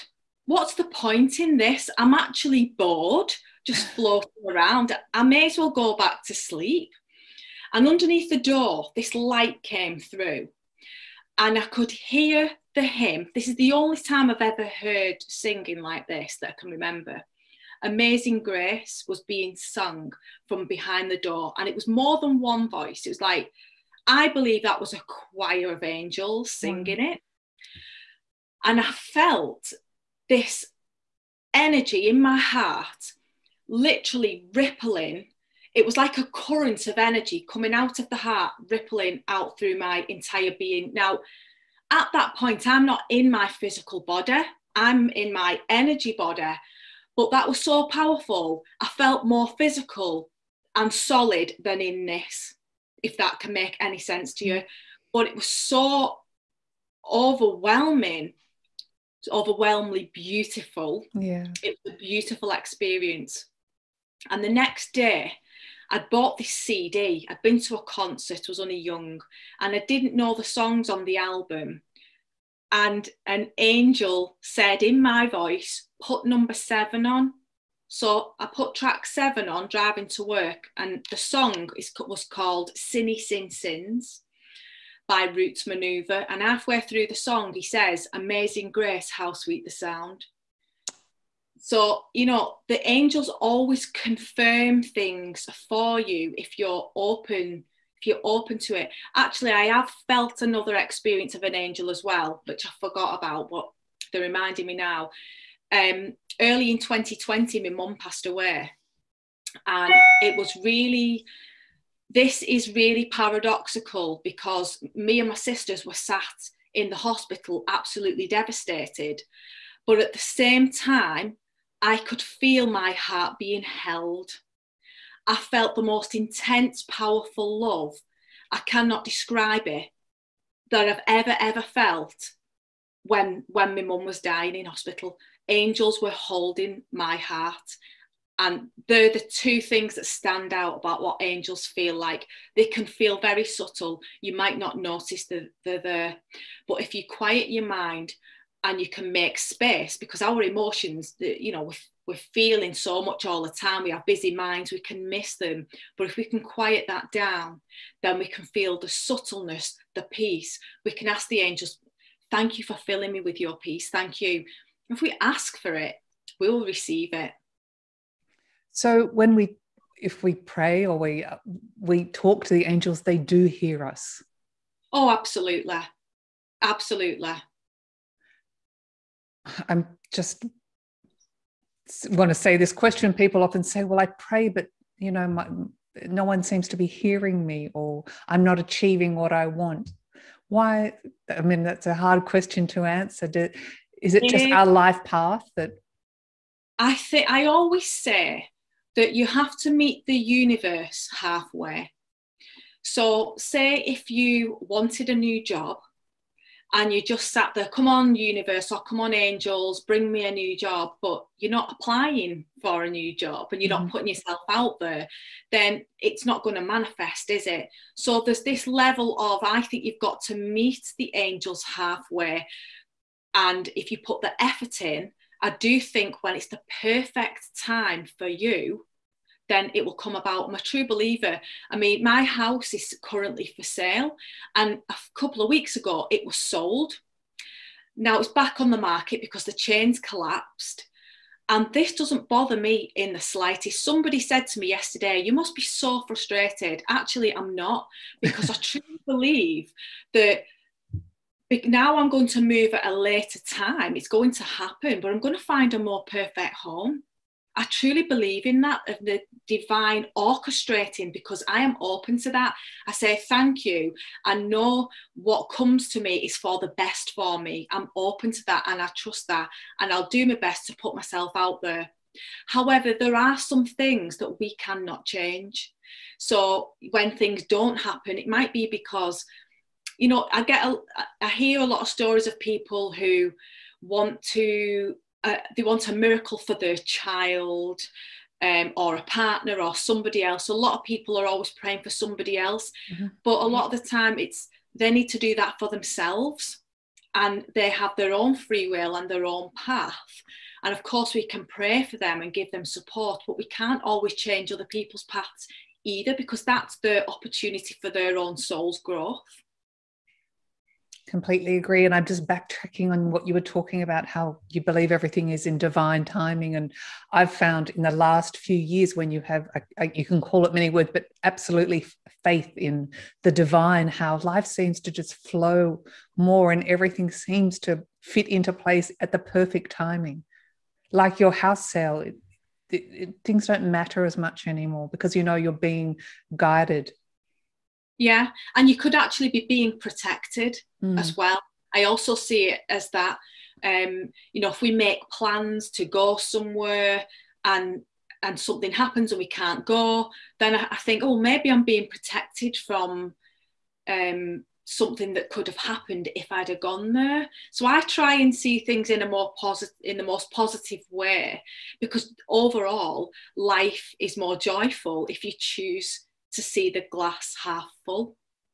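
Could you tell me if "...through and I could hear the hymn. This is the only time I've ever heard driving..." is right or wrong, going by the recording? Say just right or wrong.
wrong.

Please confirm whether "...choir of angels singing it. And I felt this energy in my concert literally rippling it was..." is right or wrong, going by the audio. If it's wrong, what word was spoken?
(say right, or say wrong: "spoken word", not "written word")
wrong: "heart", not "concert".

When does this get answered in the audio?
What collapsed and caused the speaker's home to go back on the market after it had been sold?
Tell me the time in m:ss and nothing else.
3:59.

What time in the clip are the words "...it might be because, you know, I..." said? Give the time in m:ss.
4:38.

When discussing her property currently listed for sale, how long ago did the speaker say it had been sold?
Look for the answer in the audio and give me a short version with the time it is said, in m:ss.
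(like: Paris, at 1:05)
a couple of weeks ago, at 3:54.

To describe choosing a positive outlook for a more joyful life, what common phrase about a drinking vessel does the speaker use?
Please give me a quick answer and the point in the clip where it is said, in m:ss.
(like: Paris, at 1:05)
glass half full, at 6:06.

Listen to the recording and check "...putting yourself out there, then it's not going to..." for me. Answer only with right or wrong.
right.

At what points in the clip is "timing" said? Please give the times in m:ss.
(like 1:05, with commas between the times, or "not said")
5:16, 5:29.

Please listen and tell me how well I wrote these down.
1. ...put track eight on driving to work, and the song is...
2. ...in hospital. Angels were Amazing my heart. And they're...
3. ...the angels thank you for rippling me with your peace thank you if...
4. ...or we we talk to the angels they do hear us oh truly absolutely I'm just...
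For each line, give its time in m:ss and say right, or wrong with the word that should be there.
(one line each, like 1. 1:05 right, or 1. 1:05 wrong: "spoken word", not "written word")
1. 1:18 wrong: "seven", not "eight"
2. 2:14 wrong: "holding", not "Amazing"
3. 2:41 wrong: "filling", not "rippling"
4. 2:50 wrong: "absolutely", not "truly".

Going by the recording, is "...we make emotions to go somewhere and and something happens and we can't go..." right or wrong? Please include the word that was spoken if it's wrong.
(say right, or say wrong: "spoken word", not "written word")
wrong: "plans", not "emotions".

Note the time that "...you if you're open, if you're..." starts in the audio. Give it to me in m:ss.
1:35.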